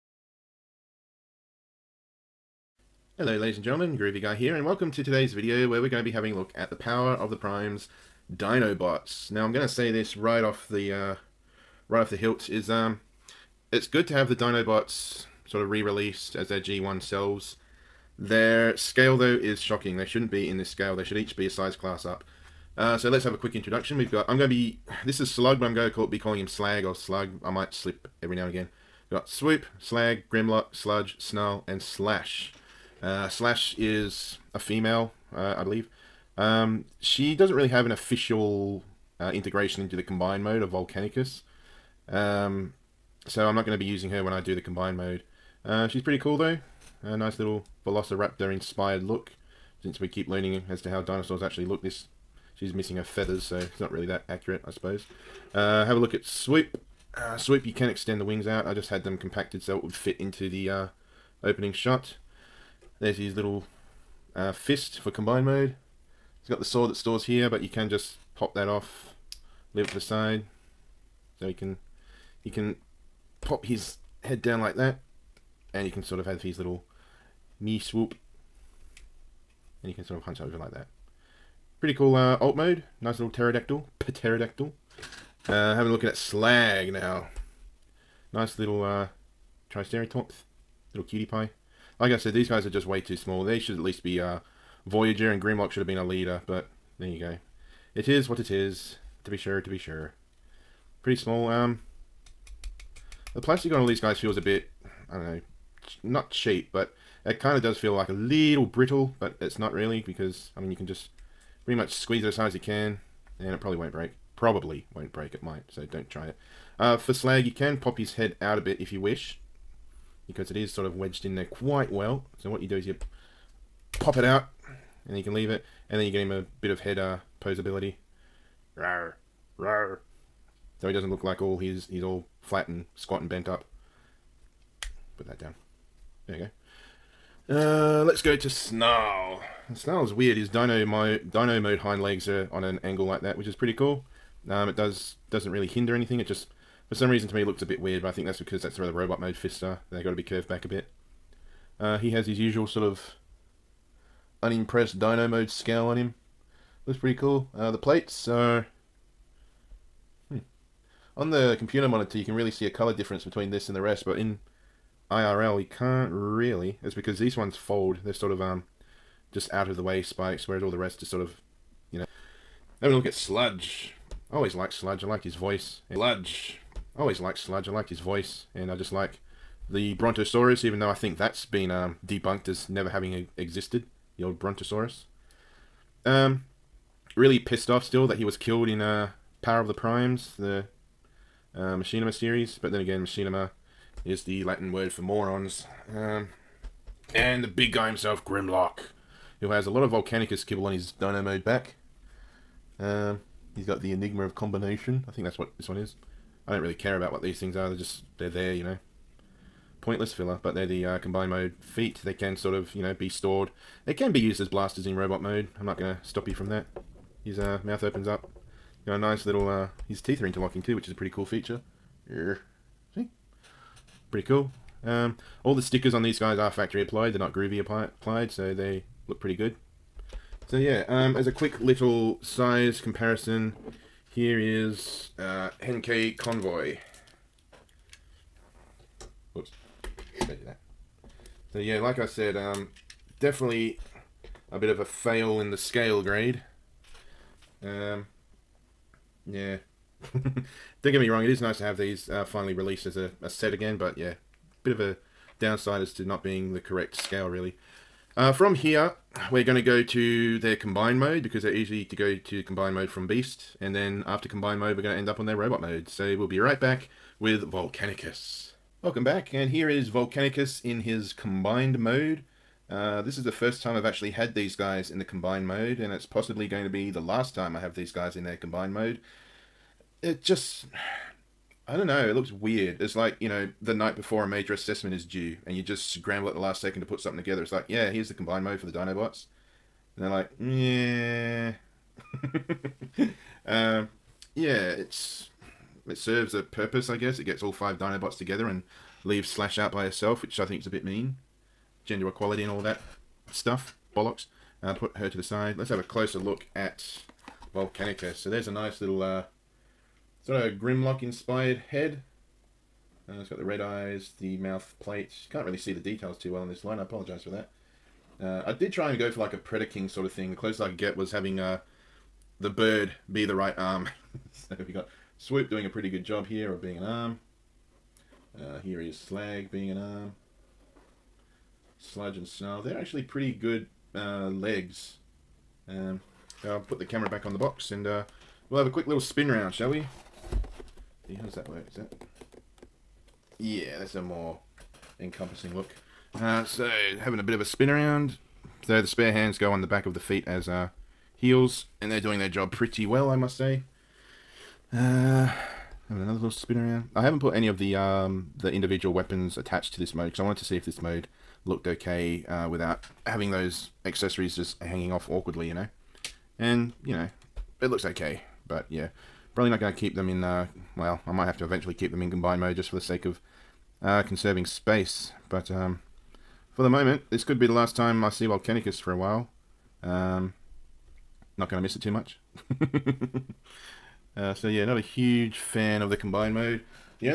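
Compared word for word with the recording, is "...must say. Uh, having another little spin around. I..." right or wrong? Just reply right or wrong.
right.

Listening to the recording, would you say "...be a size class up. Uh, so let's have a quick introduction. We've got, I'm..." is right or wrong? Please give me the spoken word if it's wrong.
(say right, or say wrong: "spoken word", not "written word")
right.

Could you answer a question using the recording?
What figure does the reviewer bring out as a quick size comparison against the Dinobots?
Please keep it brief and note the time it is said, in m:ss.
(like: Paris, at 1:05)
Henkei Convoy, at 3:55.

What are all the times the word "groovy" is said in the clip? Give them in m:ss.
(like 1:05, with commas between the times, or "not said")
0:03, 3:47.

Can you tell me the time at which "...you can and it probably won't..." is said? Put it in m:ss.
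1:52.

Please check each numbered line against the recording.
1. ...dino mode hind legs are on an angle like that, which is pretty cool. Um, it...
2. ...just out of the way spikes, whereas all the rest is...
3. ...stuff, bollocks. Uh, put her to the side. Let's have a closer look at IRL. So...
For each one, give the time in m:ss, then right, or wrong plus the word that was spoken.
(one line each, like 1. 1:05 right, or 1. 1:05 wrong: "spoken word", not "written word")
1. 2:21 right
2. 2:49 right
3. 5:03 wrong: "Volcanica", not "IRL".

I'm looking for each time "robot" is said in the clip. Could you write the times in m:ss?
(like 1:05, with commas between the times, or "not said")
2:28, 3:34, 4:25.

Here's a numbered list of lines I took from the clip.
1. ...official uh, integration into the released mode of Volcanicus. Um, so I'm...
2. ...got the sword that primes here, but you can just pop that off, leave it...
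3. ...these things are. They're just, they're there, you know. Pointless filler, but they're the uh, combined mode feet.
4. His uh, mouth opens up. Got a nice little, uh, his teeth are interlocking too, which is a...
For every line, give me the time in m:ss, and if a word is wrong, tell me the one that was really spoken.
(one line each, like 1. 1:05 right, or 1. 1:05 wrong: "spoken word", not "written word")
1. 0:37 wrong: "combined", not "released"
2. 1:06 wrong: "stores", not "primes"
3. 3:27 right
4. 3:37 right.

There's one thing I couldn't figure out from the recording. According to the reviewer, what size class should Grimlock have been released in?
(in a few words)
Leader.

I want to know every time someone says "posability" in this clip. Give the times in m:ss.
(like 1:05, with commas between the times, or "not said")
2:07.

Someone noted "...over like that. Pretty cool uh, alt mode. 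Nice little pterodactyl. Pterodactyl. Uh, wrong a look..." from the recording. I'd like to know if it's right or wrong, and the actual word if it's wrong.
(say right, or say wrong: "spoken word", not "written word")
wrong: "having", not "wrong".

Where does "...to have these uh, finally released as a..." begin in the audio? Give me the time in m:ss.
4:11.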